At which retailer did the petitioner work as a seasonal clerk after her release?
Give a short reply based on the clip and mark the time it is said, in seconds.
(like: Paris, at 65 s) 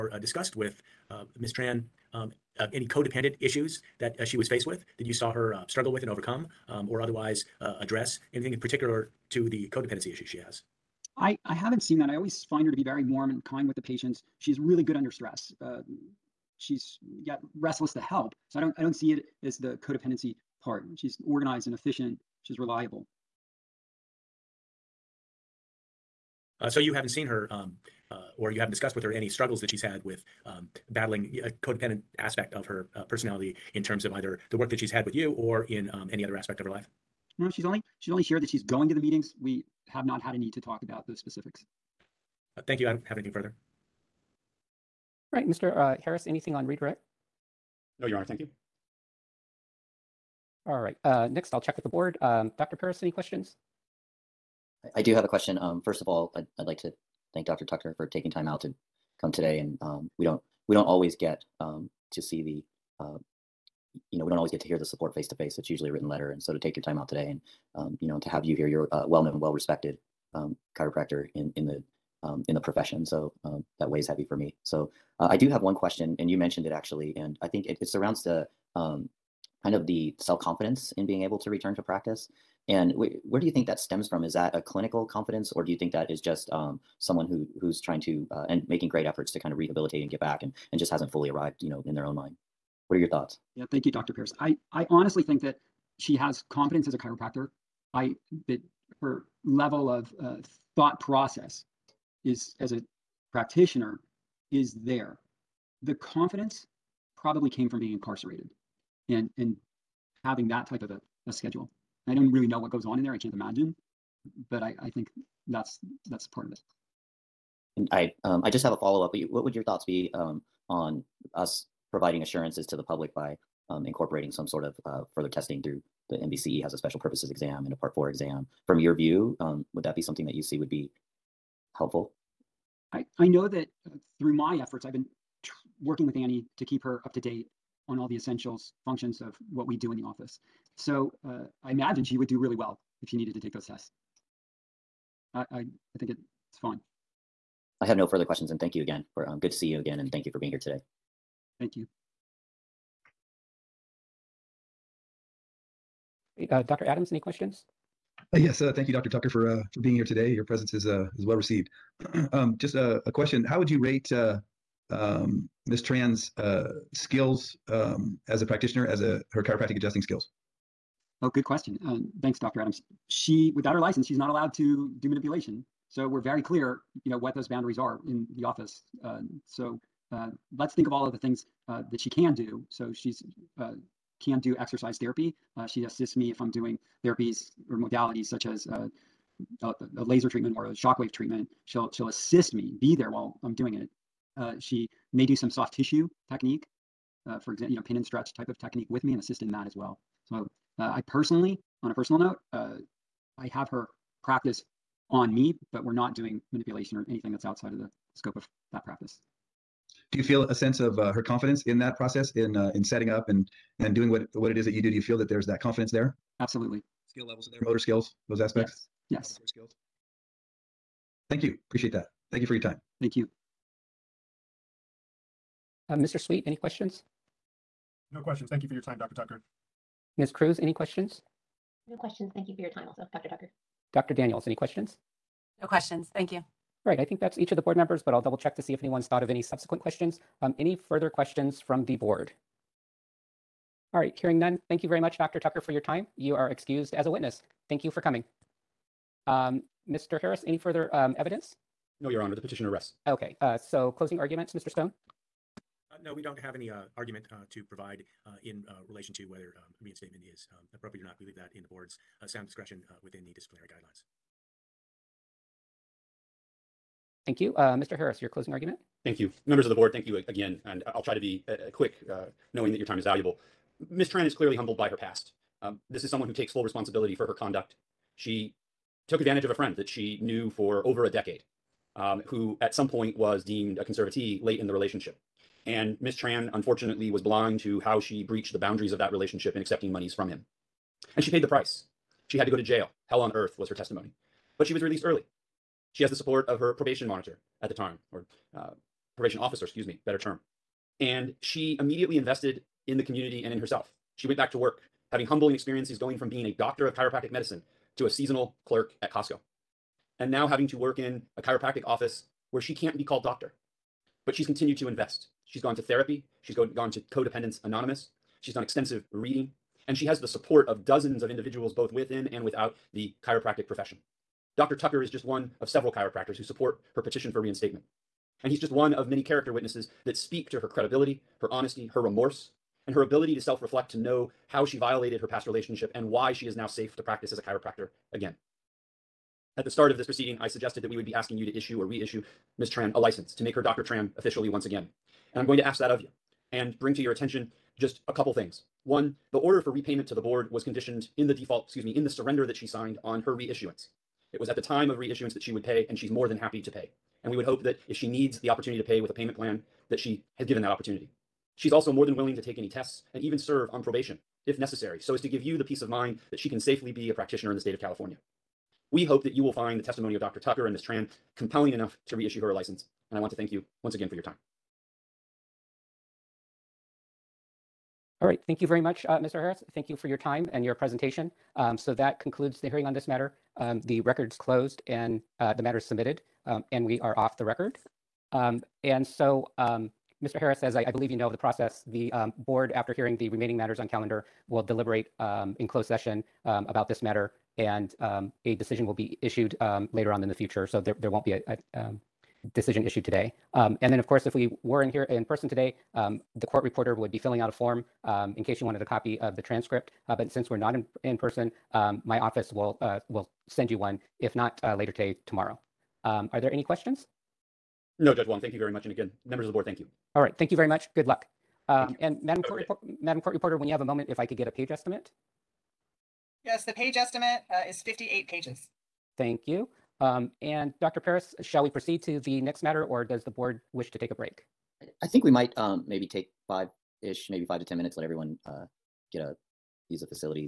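Costco, at 309 s.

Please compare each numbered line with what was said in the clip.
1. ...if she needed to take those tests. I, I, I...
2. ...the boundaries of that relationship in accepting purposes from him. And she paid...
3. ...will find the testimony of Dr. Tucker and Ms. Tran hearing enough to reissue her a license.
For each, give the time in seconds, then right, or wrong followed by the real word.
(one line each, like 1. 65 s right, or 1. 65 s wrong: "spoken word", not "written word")
1. 143 s right
2. 288 s wrong: "monies", not "purposes"
3. 369 s wrong: "compelling", not "hearing".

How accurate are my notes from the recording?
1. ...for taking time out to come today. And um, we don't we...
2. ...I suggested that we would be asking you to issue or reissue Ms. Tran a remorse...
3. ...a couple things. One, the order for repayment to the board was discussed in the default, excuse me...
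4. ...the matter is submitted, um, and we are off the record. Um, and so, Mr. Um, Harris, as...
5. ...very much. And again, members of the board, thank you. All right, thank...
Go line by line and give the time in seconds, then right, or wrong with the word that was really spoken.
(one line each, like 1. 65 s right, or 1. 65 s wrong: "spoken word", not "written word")
1. 57 s right
2. 340 s wrong: "license", not "remorse"
3. 348 s wrong: "conditioned", not "discussed"
4. 385 s right
5. 418 s right.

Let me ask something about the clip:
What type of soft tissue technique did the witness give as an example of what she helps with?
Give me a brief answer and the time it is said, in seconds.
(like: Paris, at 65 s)
pin and stretch, at 197 s.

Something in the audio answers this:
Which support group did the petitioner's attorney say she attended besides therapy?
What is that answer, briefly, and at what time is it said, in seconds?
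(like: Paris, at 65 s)
Co-Dependents Anonymous, at 317 s.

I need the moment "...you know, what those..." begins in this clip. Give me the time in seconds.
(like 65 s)
177 s.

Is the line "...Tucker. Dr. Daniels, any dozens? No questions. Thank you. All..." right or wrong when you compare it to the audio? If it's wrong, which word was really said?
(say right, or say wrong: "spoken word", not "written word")
wrong: "questions", not "dozens".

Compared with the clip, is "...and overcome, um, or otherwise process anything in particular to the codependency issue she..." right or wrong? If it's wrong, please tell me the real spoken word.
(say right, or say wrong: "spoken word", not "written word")
wrong: "address", not "process".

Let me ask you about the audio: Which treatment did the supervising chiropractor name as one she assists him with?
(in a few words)
laser treatment.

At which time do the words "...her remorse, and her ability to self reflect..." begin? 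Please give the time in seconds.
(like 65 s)
331 s.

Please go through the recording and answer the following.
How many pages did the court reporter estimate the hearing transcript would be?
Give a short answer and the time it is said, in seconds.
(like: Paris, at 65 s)
58, at 427 s.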